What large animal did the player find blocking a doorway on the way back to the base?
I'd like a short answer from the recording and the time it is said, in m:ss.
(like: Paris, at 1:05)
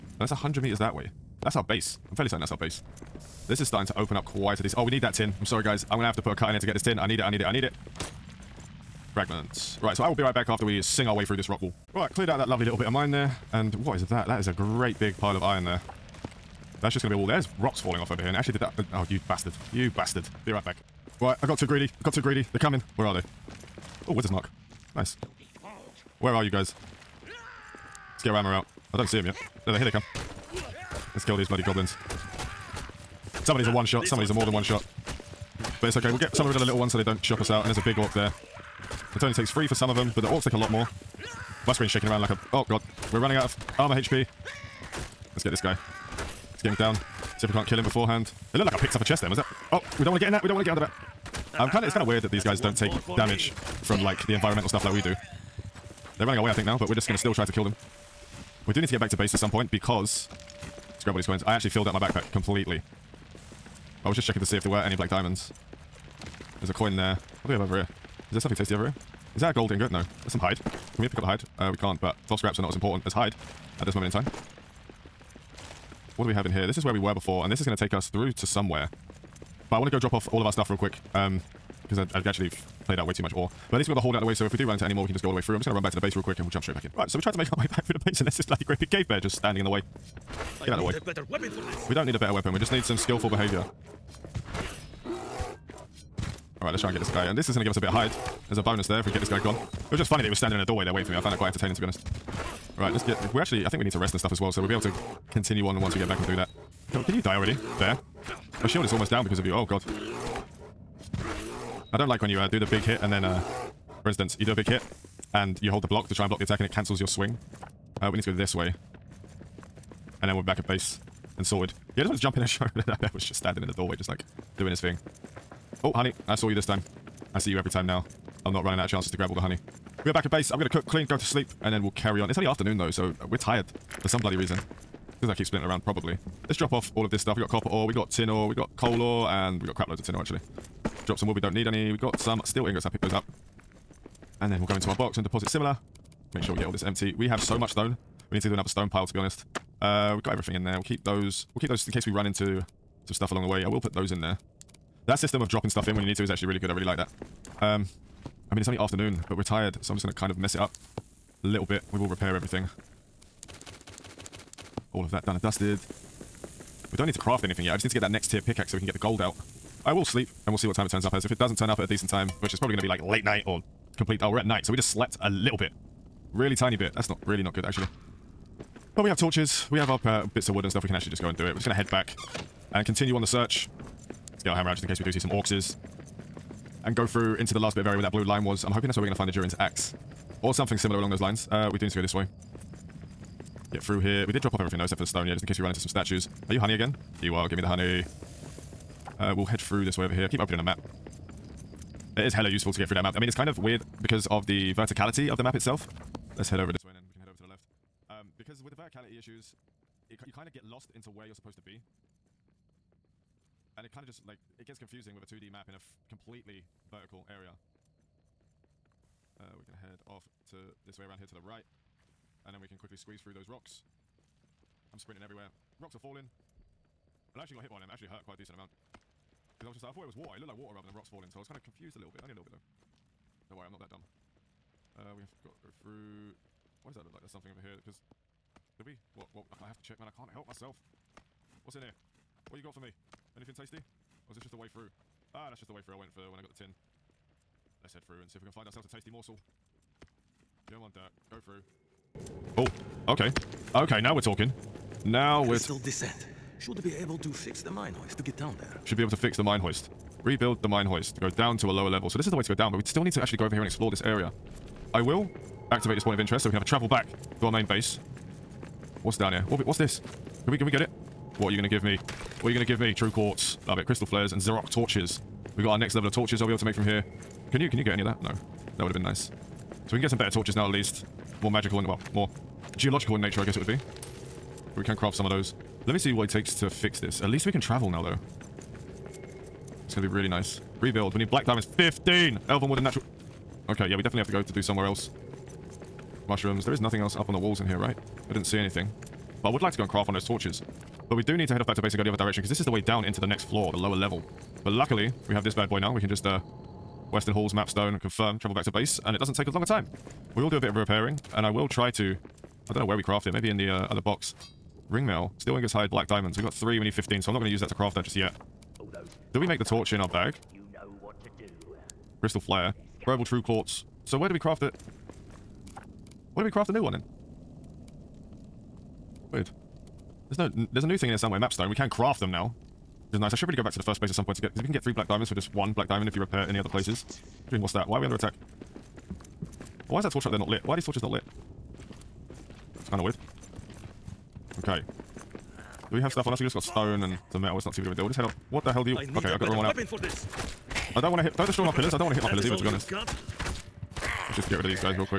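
Cave bear, at 1:28.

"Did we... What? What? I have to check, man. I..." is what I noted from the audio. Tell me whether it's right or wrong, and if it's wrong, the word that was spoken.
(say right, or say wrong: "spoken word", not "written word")
right.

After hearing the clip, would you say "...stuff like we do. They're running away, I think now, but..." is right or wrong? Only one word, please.
right.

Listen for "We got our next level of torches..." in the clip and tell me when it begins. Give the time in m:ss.
4:35.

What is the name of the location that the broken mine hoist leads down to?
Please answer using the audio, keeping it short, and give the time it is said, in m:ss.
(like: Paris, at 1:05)
Crystal descent, at 4:15.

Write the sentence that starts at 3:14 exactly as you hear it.
We did drop off everything though, except for the stone, yeah, just in case we run into some statues.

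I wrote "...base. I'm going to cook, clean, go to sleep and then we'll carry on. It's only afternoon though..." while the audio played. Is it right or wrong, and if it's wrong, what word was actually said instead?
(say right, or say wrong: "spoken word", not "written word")
right.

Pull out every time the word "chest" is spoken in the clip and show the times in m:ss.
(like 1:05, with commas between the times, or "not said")
0:49.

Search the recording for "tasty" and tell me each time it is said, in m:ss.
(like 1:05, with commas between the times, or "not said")
1:08, 4:03, 4:08.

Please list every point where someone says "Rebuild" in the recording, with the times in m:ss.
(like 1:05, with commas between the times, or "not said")
4:20, 4:50.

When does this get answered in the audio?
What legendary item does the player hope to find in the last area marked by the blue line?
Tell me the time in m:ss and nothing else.
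3:09.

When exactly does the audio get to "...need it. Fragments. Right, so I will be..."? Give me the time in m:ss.
0:07.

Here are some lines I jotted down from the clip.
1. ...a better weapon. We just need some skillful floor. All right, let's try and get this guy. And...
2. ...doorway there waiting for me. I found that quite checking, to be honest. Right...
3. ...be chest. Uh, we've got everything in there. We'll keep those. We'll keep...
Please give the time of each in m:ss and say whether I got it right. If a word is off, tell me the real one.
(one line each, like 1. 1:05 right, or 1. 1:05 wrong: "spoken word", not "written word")
1. 1:32 wrong: "behavior", not "floor"
2. 1:40 wrong: "entertaining", not "checking"
3. 2:29 wrong: "honest", not "chest".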